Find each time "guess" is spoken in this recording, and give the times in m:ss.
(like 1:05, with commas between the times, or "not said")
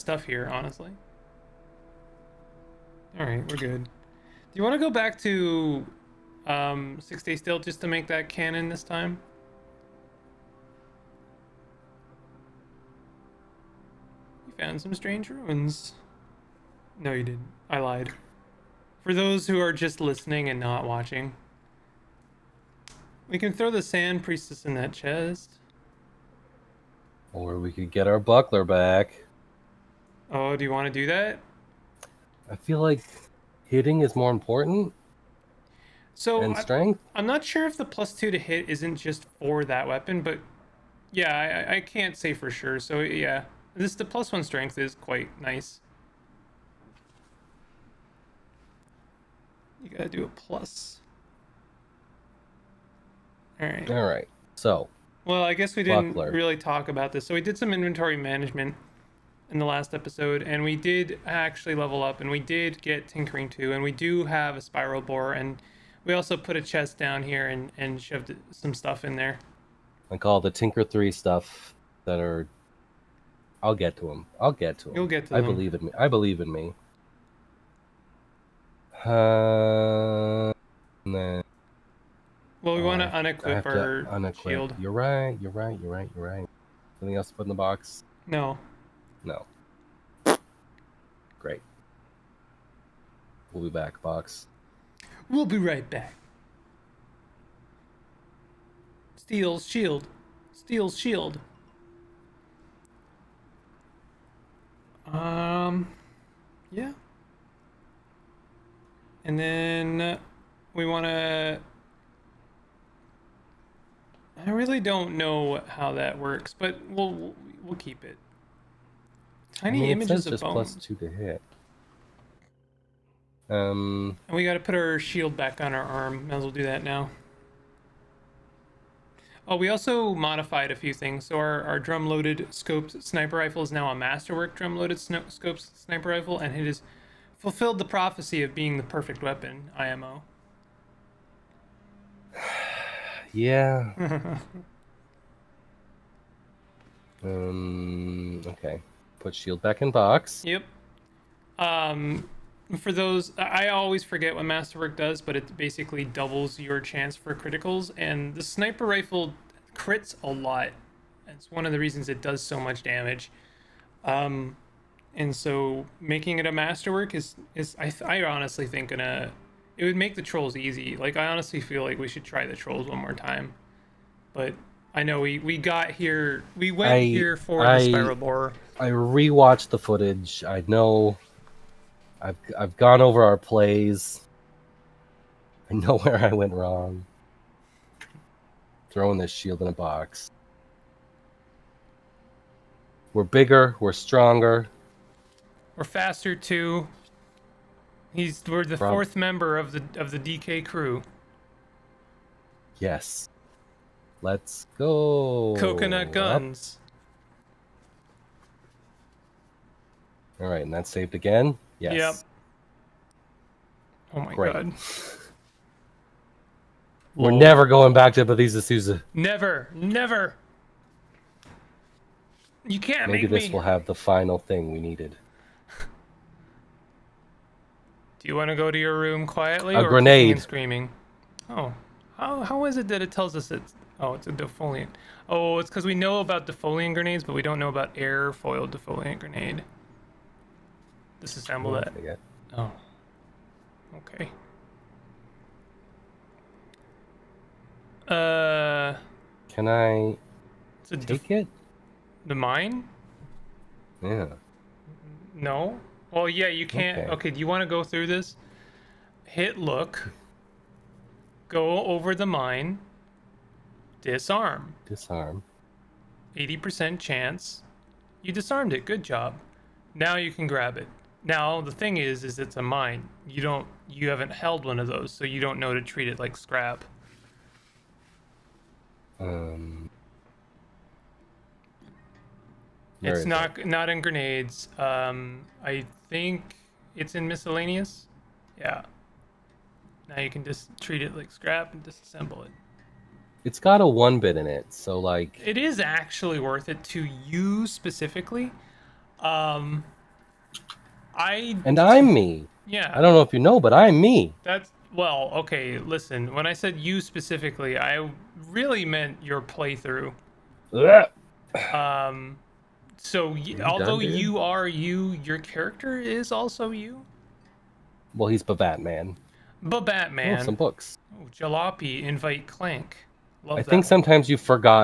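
0:55.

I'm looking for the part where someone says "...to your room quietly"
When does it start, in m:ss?
3:48.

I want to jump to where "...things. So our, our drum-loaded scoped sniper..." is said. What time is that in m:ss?
2:10.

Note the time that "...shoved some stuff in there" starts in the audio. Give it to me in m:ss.
1:08.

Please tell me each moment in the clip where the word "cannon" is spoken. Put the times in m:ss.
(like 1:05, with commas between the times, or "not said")
0:08.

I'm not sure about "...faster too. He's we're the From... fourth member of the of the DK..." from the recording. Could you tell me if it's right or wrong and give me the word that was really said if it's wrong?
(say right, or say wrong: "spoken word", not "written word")
right.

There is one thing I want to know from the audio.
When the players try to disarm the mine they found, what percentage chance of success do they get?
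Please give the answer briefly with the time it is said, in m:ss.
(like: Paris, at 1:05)
80%, at 4:26.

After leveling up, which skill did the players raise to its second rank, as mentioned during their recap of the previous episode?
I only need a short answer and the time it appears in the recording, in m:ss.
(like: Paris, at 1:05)
Tinkering 2, at 1:03.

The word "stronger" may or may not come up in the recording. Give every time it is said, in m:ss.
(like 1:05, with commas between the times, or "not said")
3:13.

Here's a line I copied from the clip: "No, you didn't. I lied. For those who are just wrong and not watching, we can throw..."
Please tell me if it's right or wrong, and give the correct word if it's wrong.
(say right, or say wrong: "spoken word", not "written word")
wrong: "listening", not "wrong".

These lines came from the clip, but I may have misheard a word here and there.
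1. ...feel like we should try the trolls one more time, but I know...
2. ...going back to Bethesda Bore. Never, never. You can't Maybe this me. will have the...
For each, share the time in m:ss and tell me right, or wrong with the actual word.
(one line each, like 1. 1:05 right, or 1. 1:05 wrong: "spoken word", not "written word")
1. 2:51 right
2. 3:37 wrong: "Susa", not "Bore".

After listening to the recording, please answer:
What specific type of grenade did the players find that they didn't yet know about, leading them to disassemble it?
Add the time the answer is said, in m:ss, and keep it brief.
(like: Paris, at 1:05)
Air foil defoliant grenade, at 3:57.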